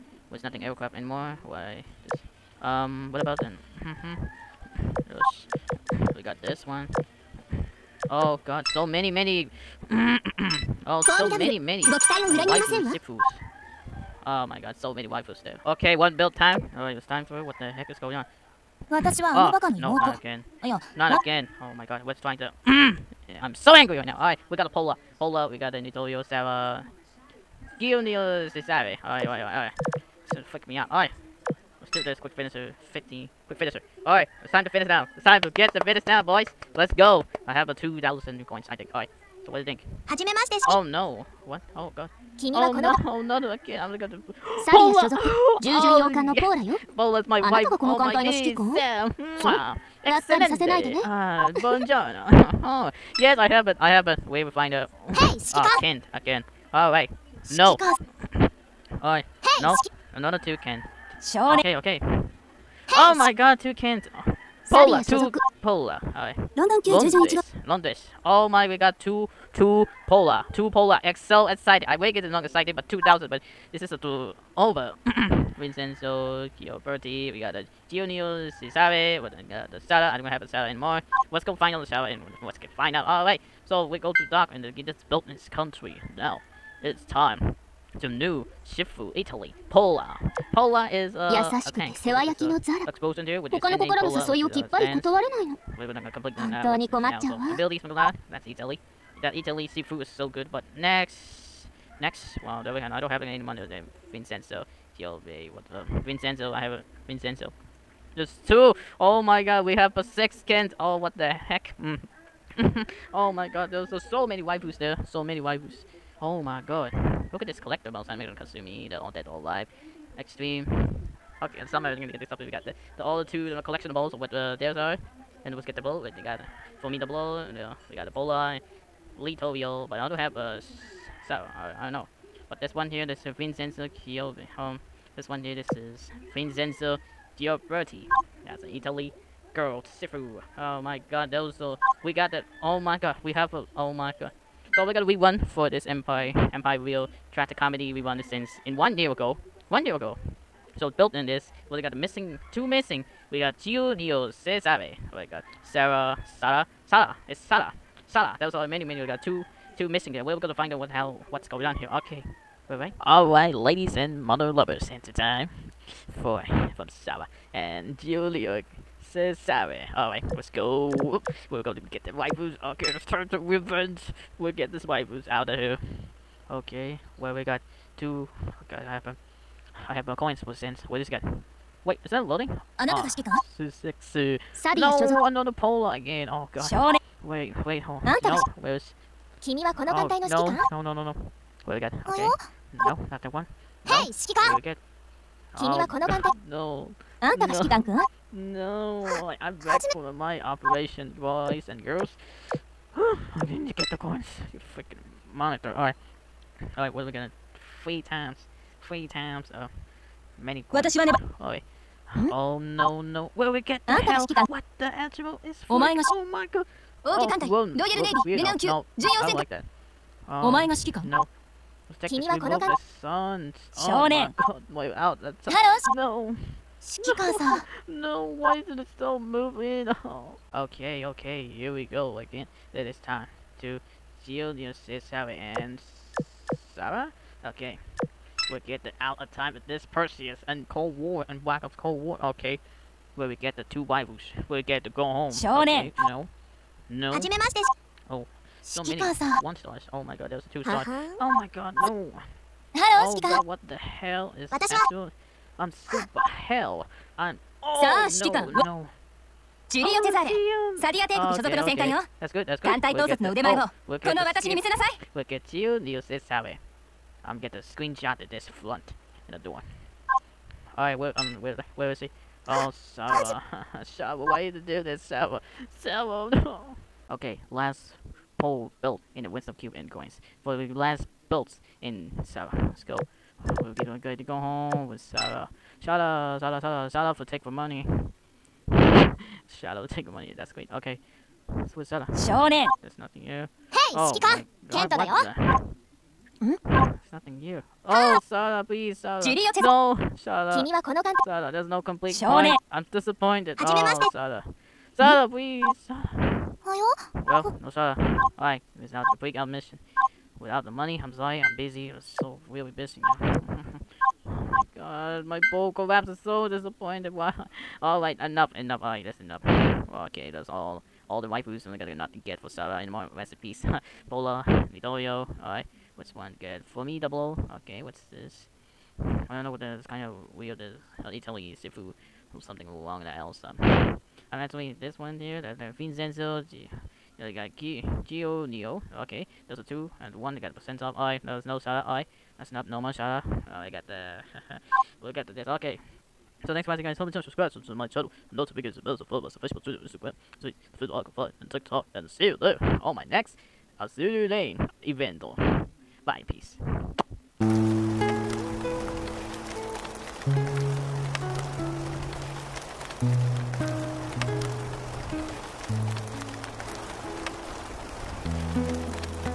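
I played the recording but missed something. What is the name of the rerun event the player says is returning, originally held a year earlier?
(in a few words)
Empire Real Tragic Comedy.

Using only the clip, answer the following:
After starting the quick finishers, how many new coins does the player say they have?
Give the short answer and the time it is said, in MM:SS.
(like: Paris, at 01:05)
2,000, at 00:37.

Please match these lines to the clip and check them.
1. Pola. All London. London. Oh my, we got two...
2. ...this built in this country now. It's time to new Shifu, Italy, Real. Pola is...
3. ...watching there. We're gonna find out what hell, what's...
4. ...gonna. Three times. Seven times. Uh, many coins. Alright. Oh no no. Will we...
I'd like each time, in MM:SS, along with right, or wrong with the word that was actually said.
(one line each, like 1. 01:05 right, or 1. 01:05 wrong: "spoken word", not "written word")
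1. 01:05 right
2. 01:24 wrong: "Pola", not "Real"
3. 02:39 wrong: "missing", not "watching"
4. 03:27 wrong: "Three", not "Seven".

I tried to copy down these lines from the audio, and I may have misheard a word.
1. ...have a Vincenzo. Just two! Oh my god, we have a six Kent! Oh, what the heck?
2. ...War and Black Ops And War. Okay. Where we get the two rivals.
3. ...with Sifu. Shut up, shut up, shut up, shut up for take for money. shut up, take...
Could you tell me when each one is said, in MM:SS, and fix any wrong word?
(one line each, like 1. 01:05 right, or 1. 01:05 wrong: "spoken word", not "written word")
1. 01:46 right
2. 04:00 wrong: "Cold", not "And"
3. 04:44 wrong: "Sarah", not "Sifu".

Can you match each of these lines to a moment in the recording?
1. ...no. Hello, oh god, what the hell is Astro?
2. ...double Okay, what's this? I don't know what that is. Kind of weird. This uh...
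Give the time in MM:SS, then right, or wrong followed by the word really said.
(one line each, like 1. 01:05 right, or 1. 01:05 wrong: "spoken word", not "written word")
1. 04:11 right
2. 05:26 right.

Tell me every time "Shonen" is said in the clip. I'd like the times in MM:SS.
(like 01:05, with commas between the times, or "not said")
04:05, 04:52.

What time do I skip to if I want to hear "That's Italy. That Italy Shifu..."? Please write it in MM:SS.
01:38.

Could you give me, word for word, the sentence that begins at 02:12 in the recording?
But this one here, this is Vincenzo Chiove.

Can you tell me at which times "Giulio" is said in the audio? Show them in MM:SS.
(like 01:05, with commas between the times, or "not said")
00:27, 01:17, 02:33, 02:47.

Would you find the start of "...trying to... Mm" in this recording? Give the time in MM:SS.
00:22.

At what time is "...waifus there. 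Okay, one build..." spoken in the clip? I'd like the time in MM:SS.
00:15.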